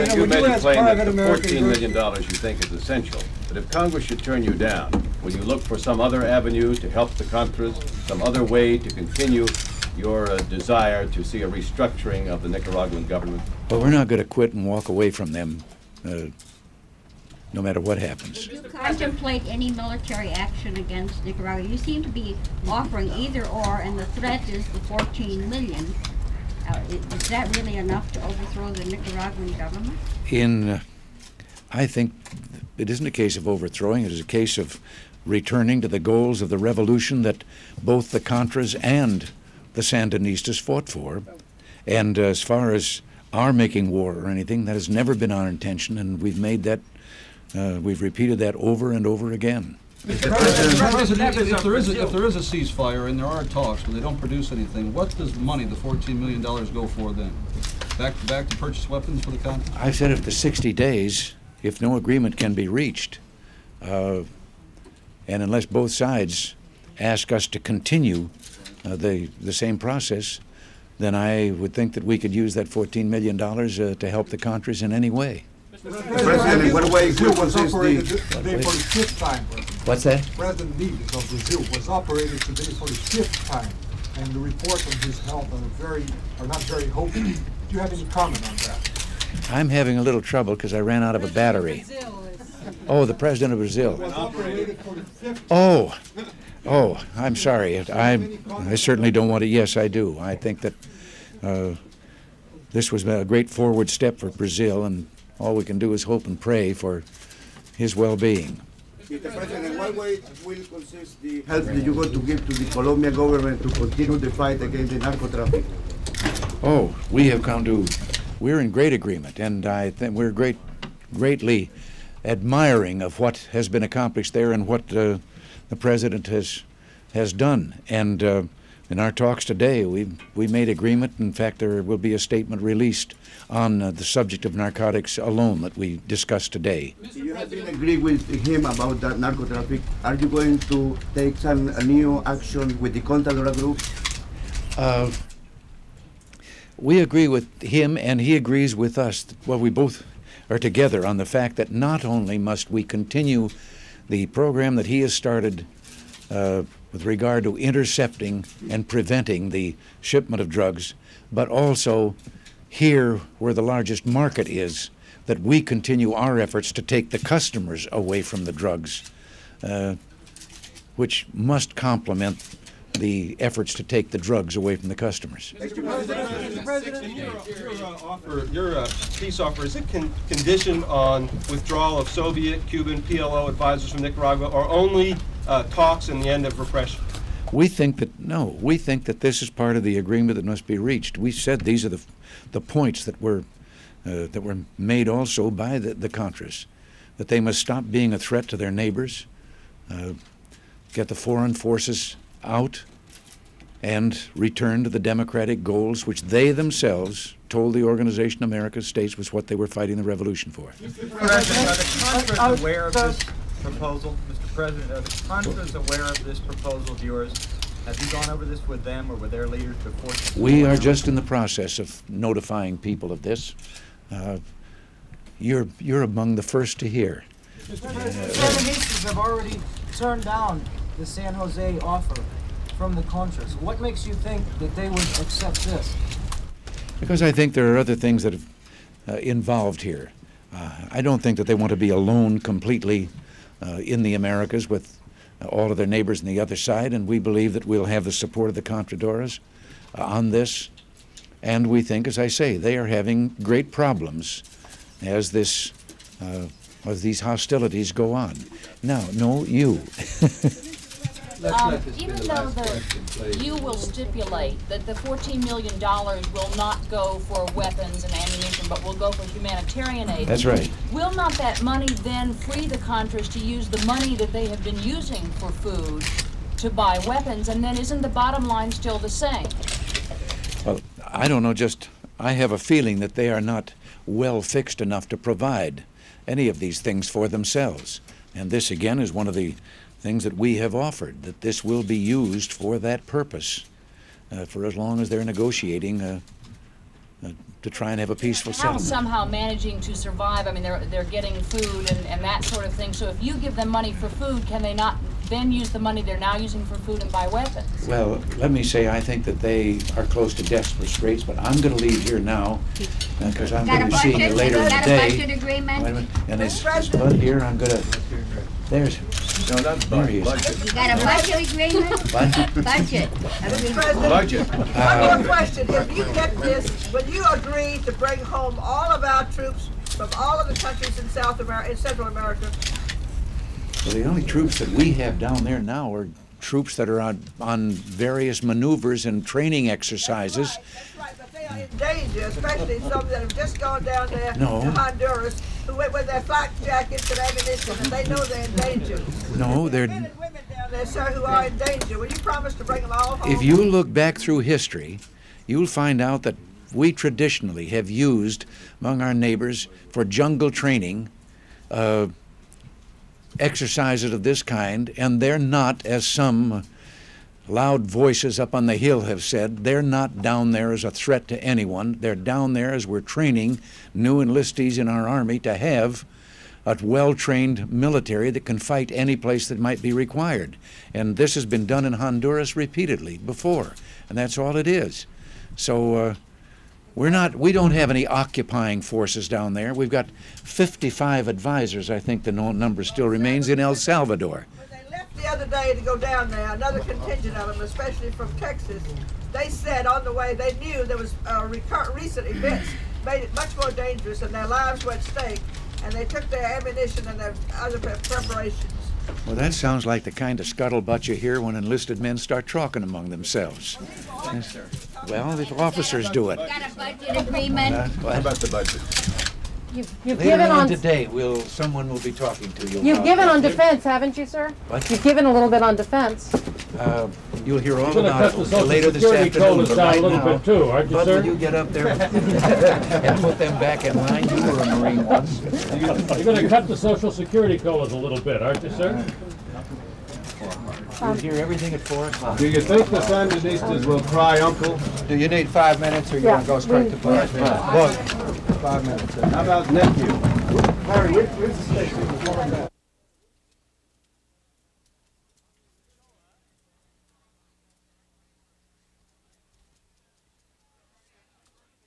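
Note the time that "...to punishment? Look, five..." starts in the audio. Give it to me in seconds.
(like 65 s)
446 s.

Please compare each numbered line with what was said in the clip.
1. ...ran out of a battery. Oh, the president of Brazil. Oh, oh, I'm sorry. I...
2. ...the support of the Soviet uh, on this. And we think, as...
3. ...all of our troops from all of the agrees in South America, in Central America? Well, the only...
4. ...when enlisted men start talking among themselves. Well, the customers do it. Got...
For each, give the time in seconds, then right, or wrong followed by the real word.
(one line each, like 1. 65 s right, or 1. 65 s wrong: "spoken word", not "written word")
1. 90 s right
2. 248 s wrong: "Contadoras", not "Soviet"
3. 328 s wrong: "countries", not "agrees"
4. 411 s wrong: "officers", not "customers".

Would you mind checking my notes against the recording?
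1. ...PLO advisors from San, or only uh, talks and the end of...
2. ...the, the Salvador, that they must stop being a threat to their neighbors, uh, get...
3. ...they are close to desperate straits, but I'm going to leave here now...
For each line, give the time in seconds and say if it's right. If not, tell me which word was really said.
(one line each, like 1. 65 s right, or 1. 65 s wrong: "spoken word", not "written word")
1. 183 s wrong: "Nicaragua", not "San"
2. 195 s wrong: "Contras", not "Salvador"
3. 309 s right.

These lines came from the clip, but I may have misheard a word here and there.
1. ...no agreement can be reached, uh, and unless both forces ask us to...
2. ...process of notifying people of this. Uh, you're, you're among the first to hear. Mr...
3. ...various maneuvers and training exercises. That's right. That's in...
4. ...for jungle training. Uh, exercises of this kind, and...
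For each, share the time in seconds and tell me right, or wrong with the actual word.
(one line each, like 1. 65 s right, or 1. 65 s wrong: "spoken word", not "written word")
1. 61 s wrong: "sides", not "forces"
2. 221 s right
3. 337 s right
4. 359 s right.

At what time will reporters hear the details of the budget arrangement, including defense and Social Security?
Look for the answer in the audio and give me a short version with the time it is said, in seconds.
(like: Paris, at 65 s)
4 o'clock, at 441 s.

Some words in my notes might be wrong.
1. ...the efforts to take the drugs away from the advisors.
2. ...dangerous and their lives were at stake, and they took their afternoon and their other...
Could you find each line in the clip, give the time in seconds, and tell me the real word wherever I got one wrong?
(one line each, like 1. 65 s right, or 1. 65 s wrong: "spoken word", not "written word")
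1. 172 s wrong: "customers", not "advisors"
2. 403 s wrong: "ammunition", not "afternoon".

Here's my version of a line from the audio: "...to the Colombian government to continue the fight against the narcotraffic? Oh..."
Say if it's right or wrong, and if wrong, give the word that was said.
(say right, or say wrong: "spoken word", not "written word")
right.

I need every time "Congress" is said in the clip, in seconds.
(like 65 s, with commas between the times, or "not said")
3 s.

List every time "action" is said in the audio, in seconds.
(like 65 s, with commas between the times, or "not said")
20 s, 142 s.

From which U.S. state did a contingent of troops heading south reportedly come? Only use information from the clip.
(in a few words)
Texas.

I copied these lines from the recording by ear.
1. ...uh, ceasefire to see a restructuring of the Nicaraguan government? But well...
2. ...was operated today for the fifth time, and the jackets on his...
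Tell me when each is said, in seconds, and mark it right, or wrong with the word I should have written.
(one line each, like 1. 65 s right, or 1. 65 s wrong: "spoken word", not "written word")
1. 10 s wrong: "desire", not "ceasefire"
2. 81 s wrong: "reports", not "jackets".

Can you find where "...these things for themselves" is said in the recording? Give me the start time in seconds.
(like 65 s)
286 s.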